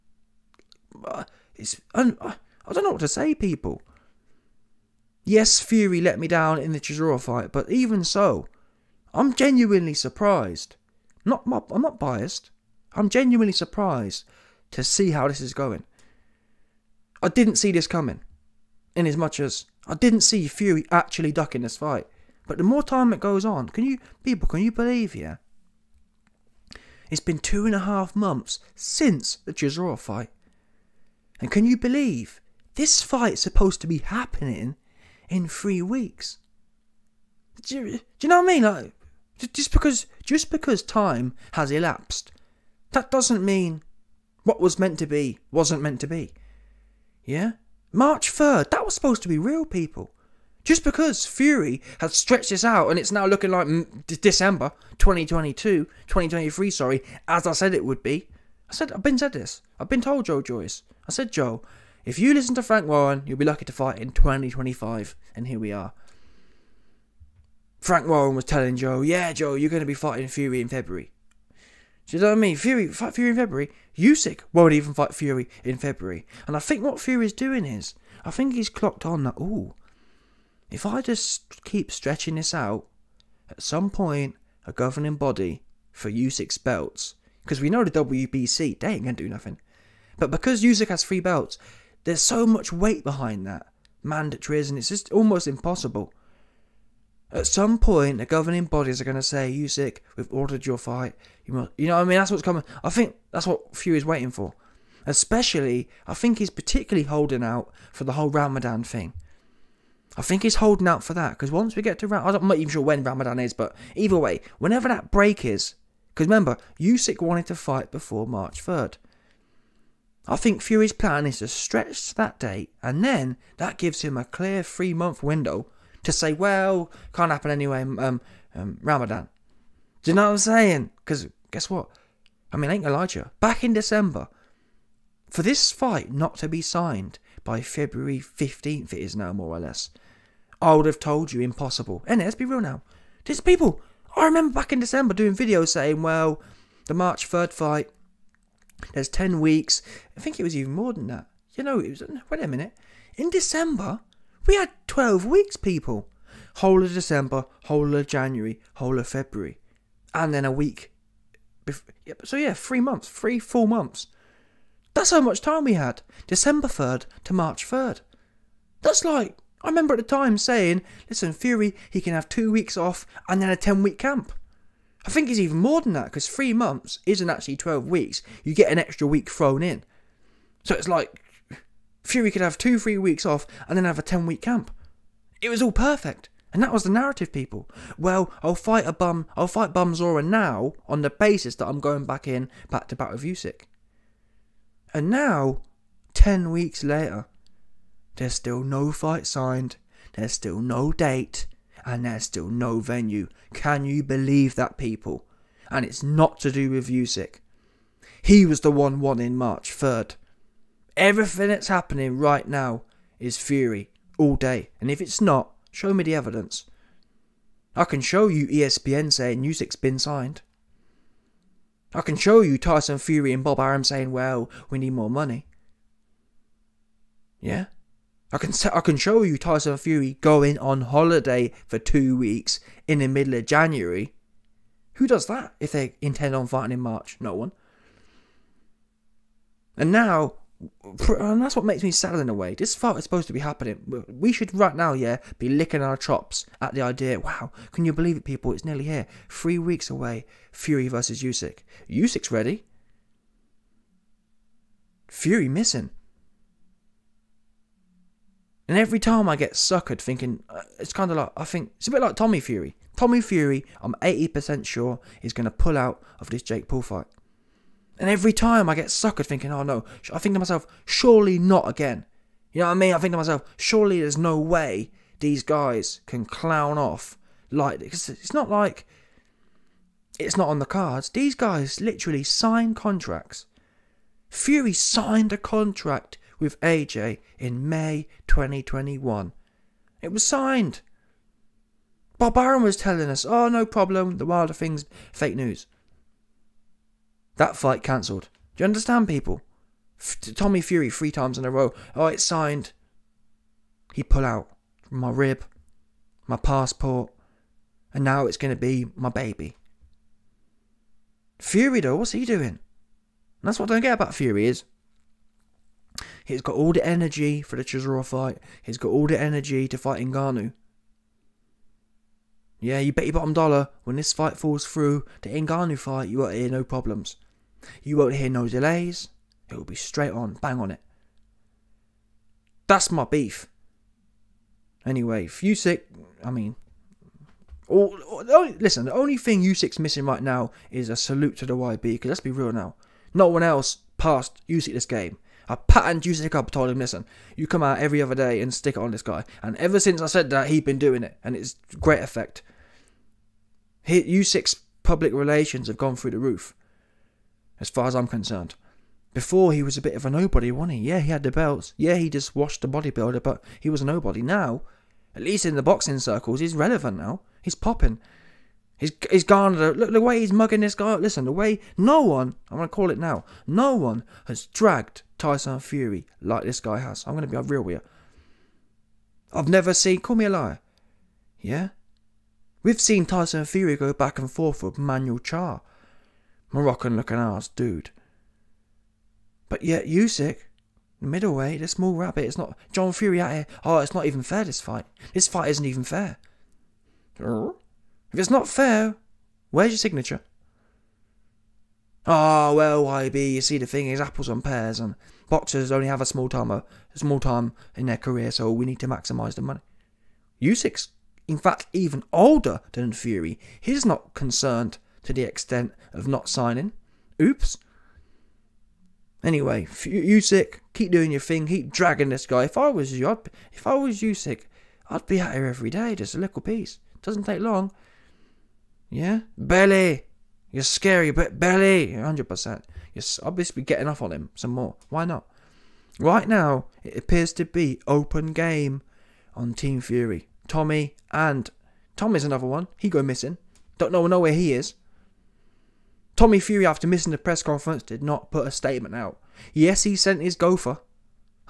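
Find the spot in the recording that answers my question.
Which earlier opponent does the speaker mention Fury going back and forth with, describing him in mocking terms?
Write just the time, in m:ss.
6:24.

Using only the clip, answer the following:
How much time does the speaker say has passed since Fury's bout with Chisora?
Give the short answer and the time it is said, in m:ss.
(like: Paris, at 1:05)
two and a half months, at 0:27.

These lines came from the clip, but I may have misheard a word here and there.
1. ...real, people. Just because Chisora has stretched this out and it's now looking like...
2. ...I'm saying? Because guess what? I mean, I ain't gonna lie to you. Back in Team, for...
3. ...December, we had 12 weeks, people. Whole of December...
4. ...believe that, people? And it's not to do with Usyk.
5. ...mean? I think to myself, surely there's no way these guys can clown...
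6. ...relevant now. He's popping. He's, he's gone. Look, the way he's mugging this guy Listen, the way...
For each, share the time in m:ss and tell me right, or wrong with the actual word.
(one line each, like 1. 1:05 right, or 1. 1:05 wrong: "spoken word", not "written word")
1. 0:49 wrong: "Fury", not "Chisora"
2. 2:10 wrong: "December", not "Team"
3. 2:33 right
4. 3:24 right
5. 4:32 right
6. 6:06 right.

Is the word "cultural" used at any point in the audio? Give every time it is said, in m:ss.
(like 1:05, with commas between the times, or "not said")
not said.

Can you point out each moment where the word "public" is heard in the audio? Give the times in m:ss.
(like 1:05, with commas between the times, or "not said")
5:54.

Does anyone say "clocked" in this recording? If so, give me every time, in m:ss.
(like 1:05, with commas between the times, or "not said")
1:18.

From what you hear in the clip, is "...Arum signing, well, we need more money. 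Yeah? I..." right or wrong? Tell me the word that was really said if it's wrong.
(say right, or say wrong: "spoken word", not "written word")
wrong: "saying", not "signing".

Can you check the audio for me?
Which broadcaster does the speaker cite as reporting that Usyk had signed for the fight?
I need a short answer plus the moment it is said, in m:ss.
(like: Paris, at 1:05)
ESPN, at 3:38.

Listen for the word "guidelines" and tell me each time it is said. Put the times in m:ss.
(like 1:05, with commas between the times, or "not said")
not said.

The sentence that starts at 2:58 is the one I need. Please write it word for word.
You get an extra week thrown in.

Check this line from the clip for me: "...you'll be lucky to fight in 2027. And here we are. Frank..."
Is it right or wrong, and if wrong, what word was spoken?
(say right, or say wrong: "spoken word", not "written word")
wrong: "2025", not "2027".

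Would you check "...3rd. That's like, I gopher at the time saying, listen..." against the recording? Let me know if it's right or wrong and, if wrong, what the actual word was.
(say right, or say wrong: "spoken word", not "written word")
wrong: "remember", not "gopher".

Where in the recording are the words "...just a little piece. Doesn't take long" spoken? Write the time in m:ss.
7:05.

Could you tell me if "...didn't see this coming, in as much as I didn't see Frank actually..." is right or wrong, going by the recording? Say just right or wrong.
wrong.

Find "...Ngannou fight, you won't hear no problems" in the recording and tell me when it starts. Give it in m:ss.
5:25.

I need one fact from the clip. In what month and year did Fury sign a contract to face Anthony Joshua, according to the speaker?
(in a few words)
May 2021.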